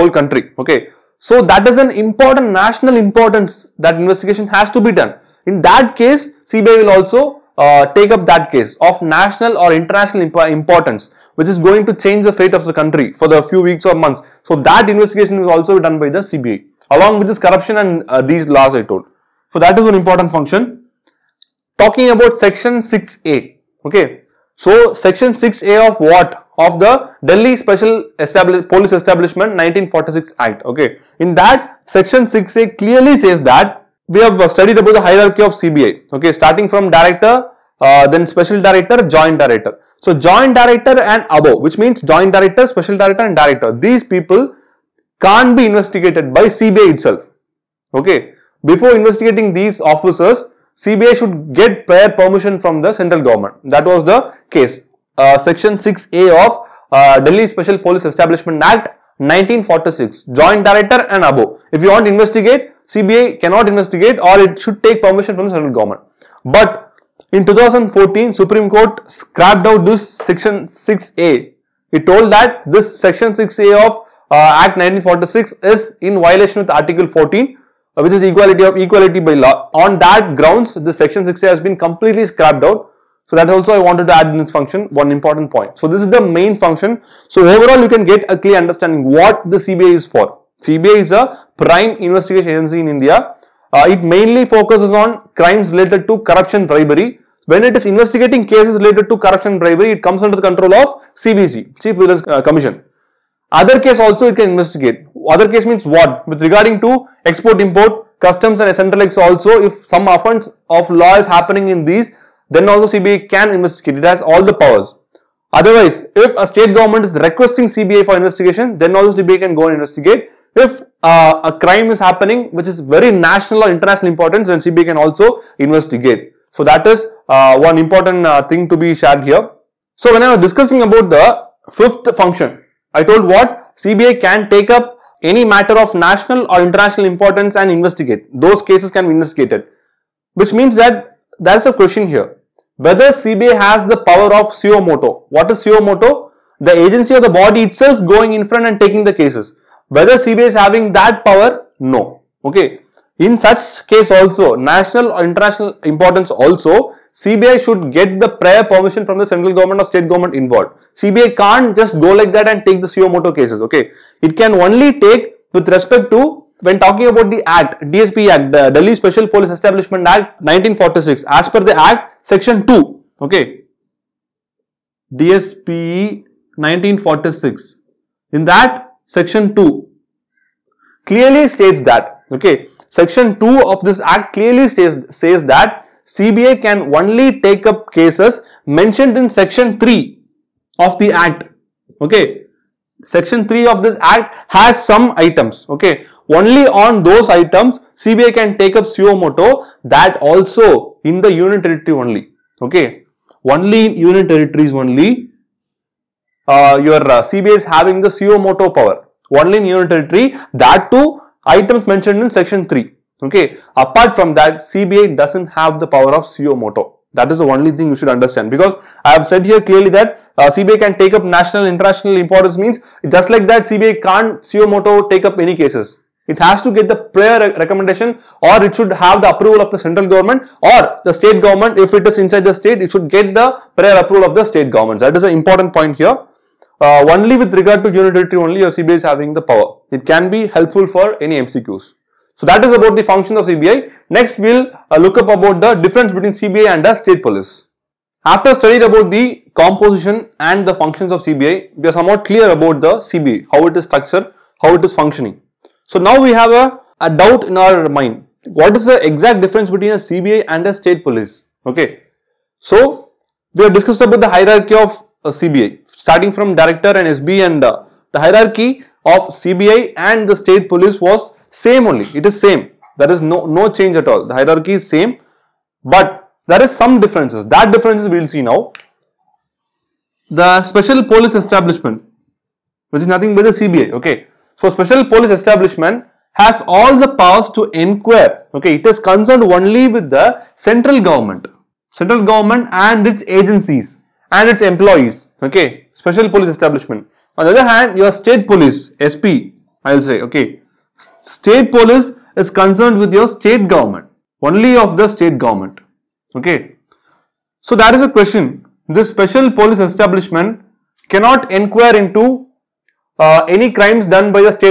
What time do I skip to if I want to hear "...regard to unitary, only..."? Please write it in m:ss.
3:57.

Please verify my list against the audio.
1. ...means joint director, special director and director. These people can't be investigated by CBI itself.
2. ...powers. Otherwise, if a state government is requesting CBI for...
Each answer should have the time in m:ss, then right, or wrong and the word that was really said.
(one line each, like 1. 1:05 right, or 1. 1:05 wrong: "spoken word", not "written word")
1. 0:41 right
2. 1:54 right.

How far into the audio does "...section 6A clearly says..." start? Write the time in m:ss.
0:31.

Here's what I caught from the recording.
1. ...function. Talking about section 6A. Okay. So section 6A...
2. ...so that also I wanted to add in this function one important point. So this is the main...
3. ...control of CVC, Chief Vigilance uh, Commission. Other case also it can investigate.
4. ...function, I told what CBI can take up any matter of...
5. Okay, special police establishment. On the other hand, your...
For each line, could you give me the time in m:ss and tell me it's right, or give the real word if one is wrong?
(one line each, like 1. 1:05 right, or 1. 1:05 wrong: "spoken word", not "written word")
1. 0:20 right
2. 1:23 right
3. 1:40 right
4. 2:12 right
5. 4:55 right.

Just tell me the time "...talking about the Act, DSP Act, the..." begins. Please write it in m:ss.
2:46.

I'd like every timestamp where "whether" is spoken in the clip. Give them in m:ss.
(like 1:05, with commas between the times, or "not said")
2:22, 2:29.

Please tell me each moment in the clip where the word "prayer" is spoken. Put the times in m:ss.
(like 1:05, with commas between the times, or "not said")
3:46, 3:53.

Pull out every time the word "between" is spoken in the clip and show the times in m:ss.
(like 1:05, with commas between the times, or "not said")
4:06, 4:19.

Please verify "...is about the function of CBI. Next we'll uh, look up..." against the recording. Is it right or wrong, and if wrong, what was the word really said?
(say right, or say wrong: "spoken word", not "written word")
right.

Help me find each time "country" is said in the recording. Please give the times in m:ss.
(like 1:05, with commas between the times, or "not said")
0:00, 0:12.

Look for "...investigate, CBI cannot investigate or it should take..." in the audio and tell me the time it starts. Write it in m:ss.
1:02.